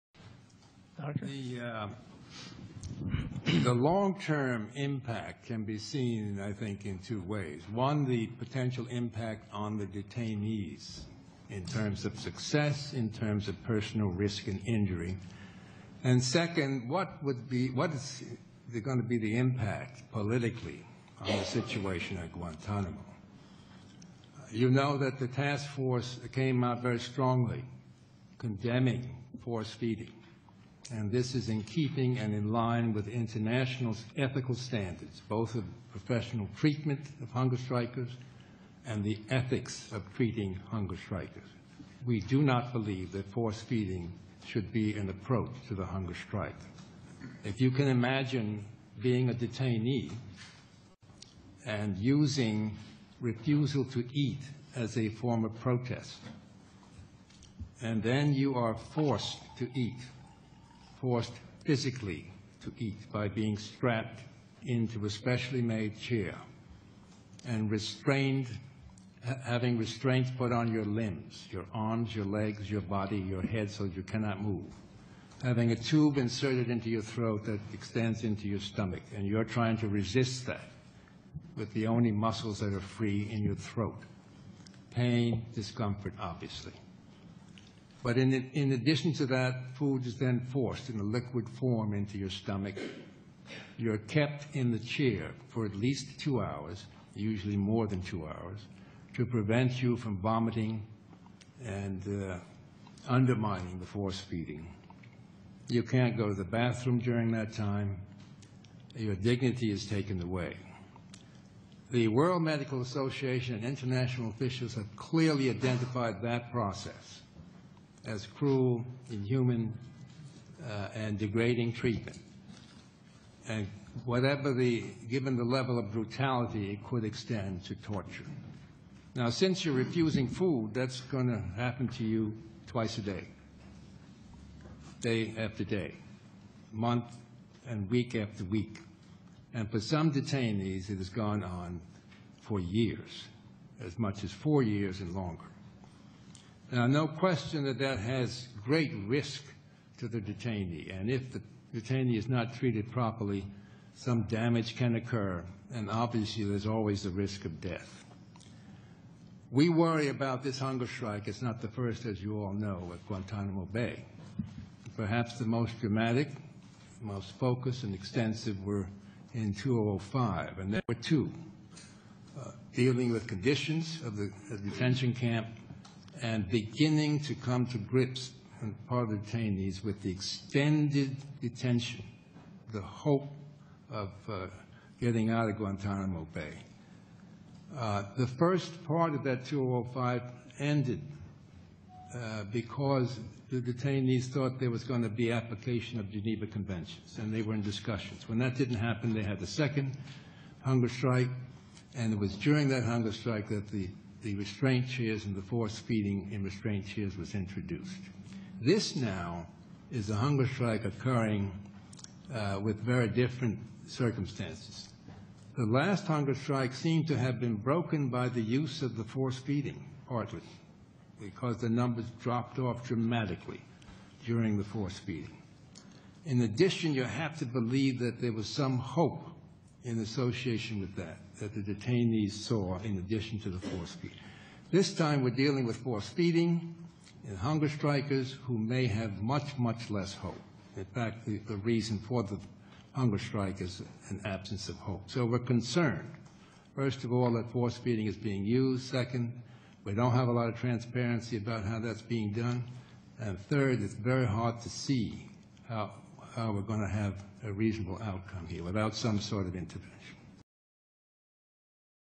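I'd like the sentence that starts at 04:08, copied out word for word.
Second, we don't have a lot of transparency about how that's being done.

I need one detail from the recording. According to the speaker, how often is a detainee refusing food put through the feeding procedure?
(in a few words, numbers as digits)
twice a day.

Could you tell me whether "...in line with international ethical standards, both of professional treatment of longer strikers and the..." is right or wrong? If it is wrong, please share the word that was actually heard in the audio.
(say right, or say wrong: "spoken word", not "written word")
wrong: "hunger", not "longer".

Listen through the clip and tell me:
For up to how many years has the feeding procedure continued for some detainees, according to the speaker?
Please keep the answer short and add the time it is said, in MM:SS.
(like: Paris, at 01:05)
4 years, at 02:24.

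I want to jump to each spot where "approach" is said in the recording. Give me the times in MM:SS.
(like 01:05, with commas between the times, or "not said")
00:45.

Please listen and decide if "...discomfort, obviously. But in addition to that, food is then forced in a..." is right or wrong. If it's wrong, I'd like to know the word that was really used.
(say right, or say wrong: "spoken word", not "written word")
right.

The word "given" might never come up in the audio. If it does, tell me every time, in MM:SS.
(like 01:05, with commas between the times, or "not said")
02:05.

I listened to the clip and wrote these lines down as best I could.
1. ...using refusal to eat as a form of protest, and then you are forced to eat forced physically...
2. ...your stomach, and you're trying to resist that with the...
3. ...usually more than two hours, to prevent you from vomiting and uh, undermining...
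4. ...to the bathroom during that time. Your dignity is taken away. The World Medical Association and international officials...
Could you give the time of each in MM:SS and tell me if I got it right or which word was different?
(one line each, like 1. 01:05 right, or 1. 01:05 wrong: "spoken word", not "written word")
1. 00:51 right
2. 01:18 right
3. 01:37 right
4. 01:46 right.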